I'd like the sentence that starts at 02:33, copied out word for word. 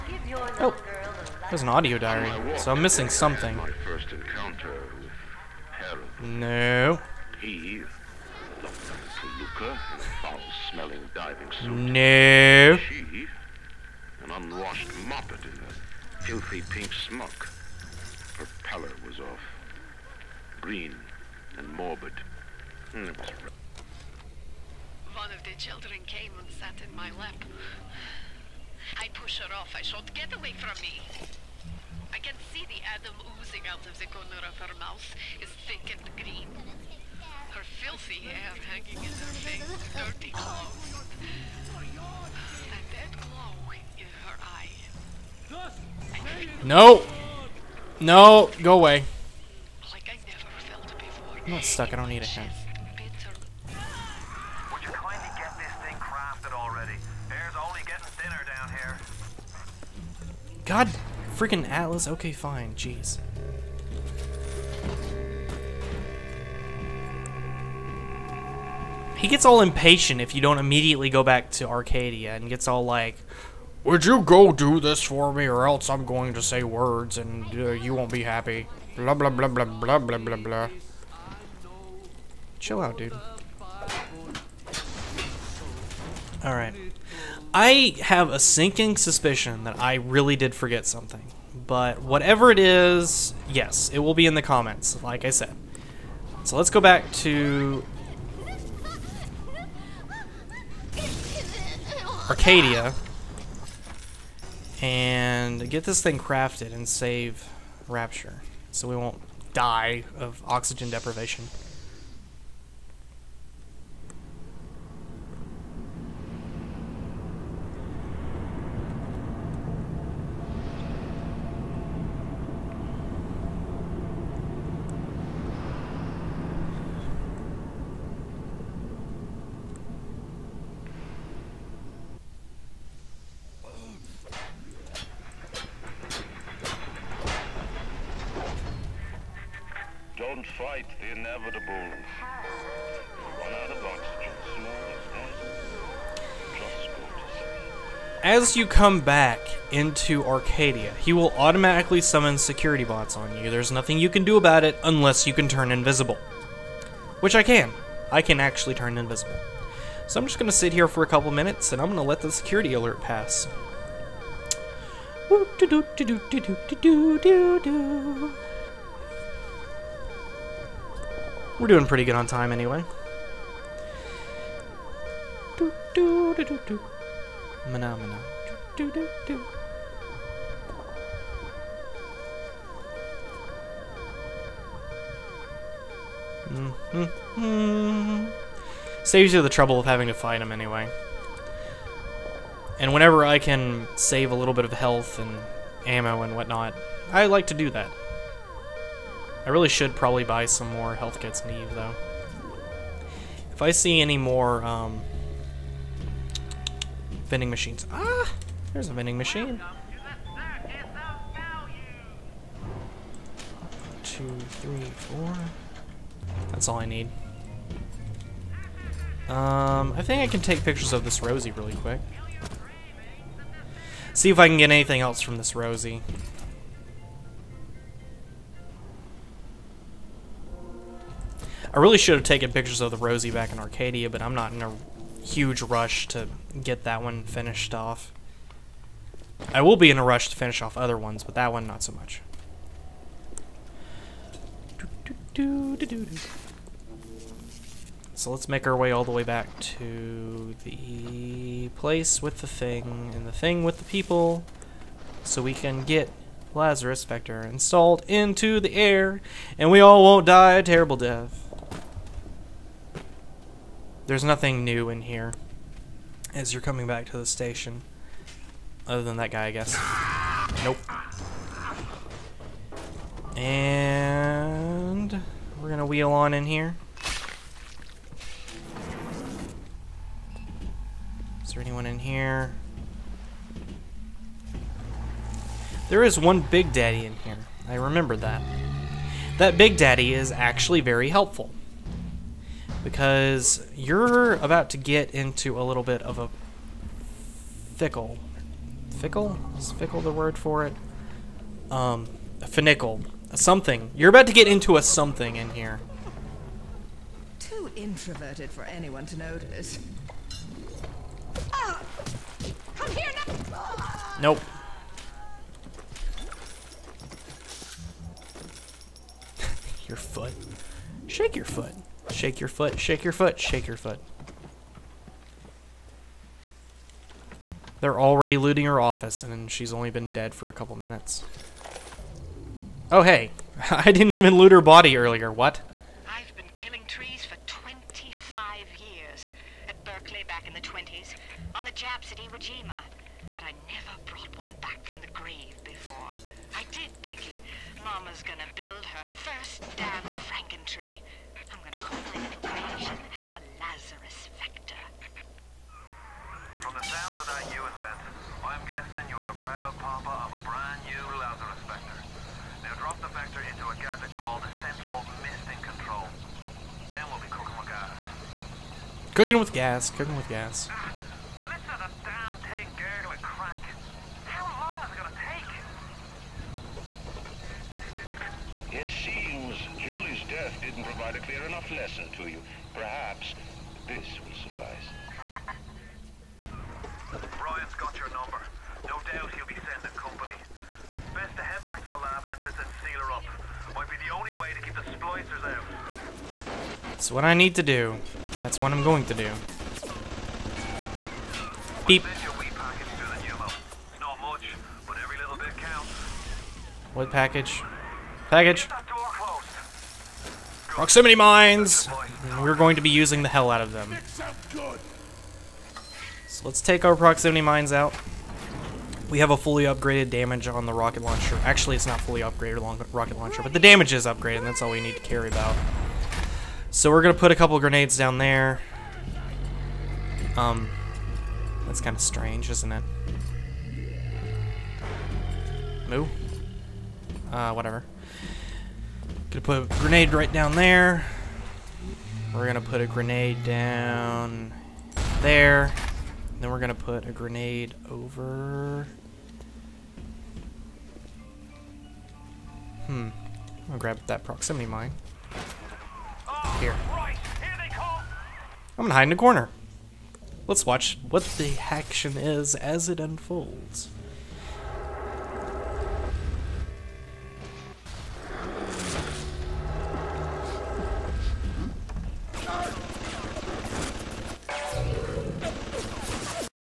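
There's nothing you can do about it unless you can turn invisible.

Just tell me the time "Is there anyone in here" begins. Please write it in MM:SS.
04:41.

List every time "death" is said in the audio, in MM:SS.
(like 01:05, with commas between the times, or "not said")
04:20, 06:20.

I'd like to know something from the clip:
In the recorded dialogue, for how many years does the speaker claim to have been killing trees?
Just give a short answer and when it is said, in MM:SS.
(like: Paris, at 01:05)
25, at 05:37.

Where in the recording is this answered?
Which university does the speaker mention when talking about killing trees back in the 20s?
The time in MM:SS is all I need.
05:39.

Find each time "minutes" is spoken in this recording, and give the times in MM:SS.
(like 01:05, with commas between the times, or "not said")
02:41, 05:30.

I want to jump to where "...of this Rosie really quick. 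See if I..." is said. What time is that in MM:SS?
03:40.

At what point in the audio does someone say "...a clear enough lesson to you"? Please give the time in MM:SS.
06:21.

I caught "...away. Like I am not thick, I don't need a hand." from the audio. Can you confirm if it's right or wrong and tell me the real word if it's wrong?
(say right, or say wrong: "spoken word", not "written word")
wrong: "stuck", not "thick".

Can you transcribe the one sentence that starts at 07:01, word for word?
Actually, it's not fully upgraded rocket launcher, but the damage is upgraded, and that's all we need to care about.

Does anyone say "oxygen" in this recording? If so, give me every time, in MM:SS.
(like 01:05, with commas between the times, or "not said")
01:50, 02:23.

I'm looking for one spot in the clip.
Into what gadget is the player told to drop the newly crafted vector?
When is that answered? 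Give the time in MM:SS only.
06:04.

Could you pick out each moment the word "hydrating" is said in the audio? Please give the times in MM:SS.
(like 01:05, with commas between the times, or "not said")
not said.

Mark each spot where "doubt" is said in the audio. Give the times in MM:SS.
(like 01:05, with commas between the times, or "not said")
06:29.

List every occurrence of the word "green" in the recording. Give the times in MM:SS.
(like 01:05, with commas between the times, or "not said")
00:20, 00:36.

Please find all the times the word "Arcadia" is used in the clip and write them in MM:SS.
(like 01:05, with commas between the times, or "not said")
01:11, 01:42, 02:30, 03:53.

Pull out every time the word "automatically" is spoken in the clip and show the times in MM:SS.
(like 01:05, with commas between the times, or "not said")
02:31.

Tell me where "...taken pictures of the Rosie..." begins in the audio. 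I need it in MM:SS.
03:52.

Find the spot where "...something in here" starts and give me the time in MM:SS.
05:04.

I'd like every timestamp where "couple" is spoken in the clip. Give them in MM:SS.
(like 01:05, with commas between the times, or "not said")
02:41, 05:30, 07:07.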